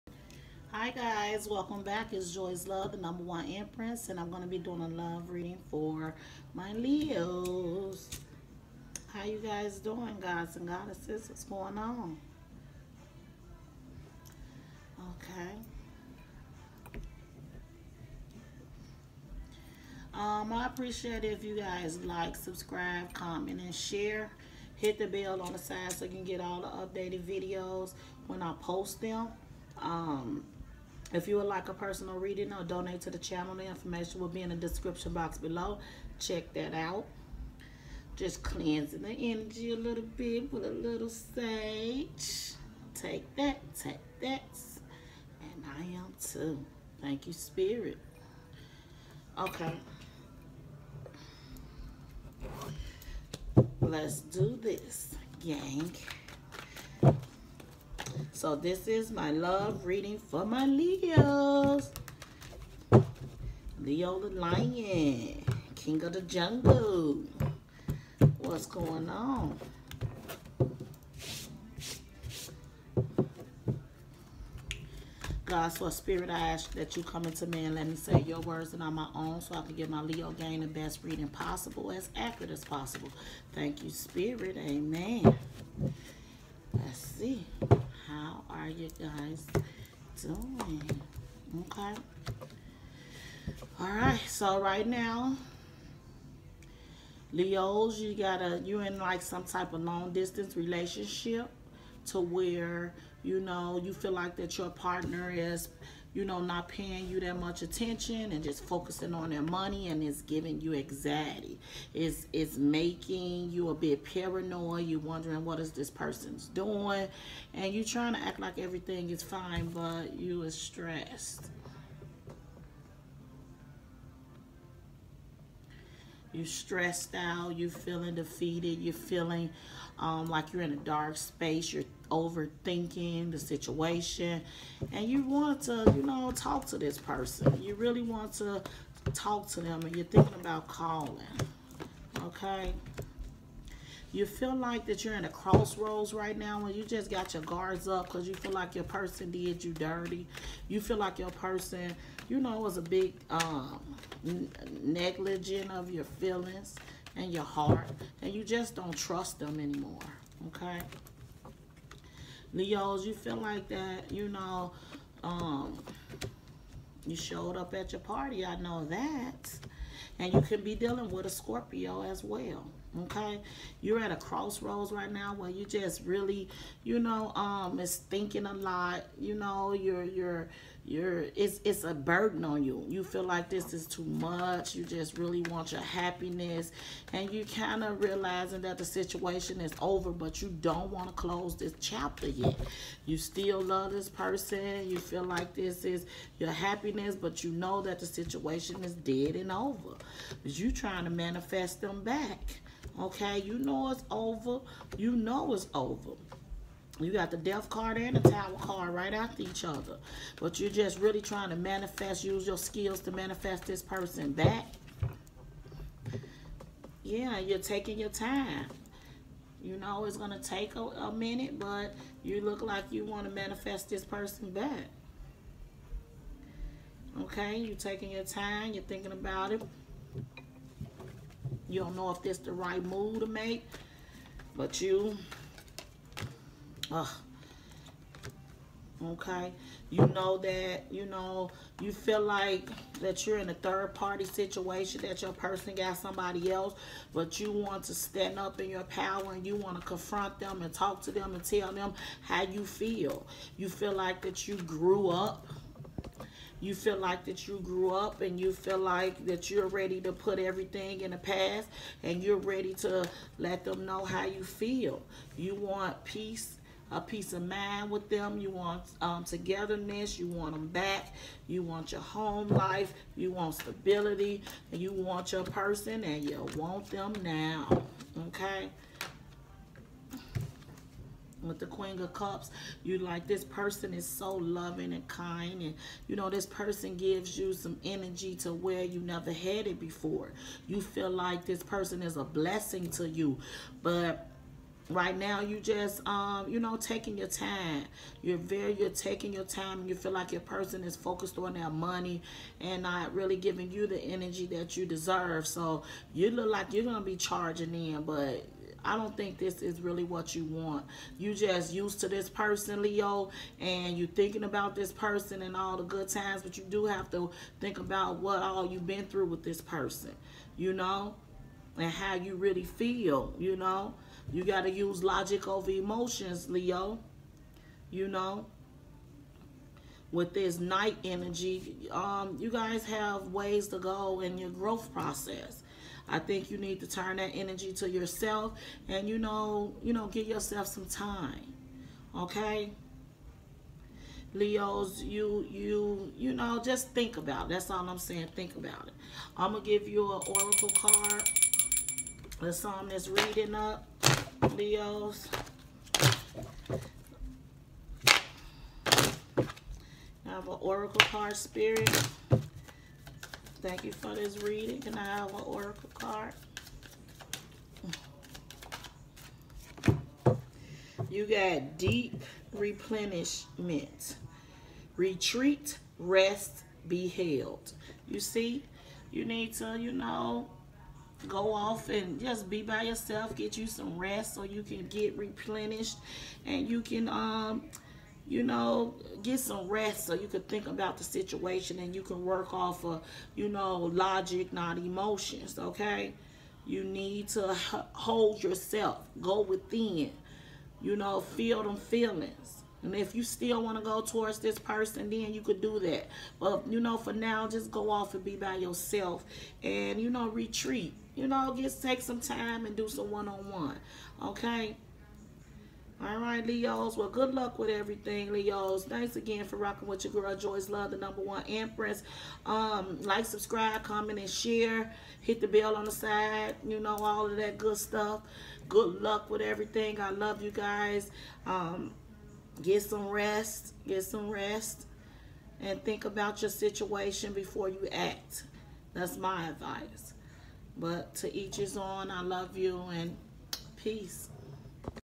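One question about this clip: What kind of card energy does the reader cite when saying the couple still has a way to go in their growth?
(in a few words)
knight.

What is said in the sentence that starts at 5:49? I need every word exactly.
I'm gonna give you an oracle card.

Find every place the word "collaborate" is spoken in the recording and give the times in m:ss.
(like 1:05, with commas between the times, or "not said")
not said.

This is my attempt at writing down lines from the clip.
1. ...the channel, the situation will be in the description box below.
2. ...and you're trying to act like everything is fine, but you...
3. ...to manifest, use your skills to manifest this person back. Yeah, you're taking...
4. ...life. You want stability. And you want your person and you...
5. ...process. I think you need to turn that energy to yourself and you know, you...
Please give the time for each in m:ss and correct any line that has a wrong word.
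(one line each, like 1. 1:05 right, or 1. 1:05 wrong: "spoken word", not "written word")
1. 0:33 wrong: "information", not "situation"
2. 1:57 right
3. 3:31 right
4. 4:32 right
5. 5:34 right.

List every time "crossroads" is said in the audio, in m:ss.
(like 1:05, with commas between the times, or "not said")
2:25, 2:54.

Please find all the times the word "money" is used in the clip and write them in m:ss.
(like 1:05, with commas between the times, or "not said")
1:49, 5:01.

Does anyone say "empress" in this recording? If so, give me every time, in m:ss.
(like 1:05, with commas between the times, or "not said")
0:03, 7:01.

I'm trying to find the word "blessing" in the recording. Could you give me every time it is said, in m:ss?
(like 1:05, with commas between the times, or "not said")
4:52.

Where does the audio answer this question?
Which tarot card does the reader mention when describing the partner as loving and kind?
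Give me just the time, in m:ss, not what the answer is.
4:41.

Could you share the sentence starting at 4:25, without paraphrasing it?
You want peace a peace of mind with them.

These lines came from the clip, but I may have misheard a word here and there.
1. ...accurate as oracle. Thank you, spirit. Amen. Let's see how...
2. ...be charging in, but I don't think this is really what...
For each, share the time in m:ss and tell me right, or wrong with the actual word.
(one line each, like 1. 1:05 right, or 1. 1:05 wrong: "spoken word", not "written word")
1. 1:22 wrong: "possible", not "oracle"
2. 5:07 right.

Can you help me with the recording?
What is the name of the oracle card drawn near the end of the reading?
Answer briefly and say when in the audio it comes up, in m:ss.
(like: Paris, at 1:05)
Deep Replenishment, at 6:11.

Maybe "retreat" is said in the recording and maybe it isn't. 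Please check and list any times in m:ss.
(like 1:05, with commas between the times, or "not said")
6:14, 6:50.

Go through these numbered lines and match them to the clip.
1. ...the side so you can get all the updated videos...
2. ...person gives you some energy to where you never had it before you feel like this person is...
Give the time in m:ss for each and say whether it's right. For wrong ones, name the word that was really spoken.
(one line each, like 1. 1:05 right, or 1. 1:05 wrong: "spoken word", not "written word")
1. 0:25 right
2. 4:46 right.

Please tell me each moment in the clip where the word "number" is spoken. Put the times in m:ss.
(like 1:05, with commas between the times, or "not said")
0:02, 7:00.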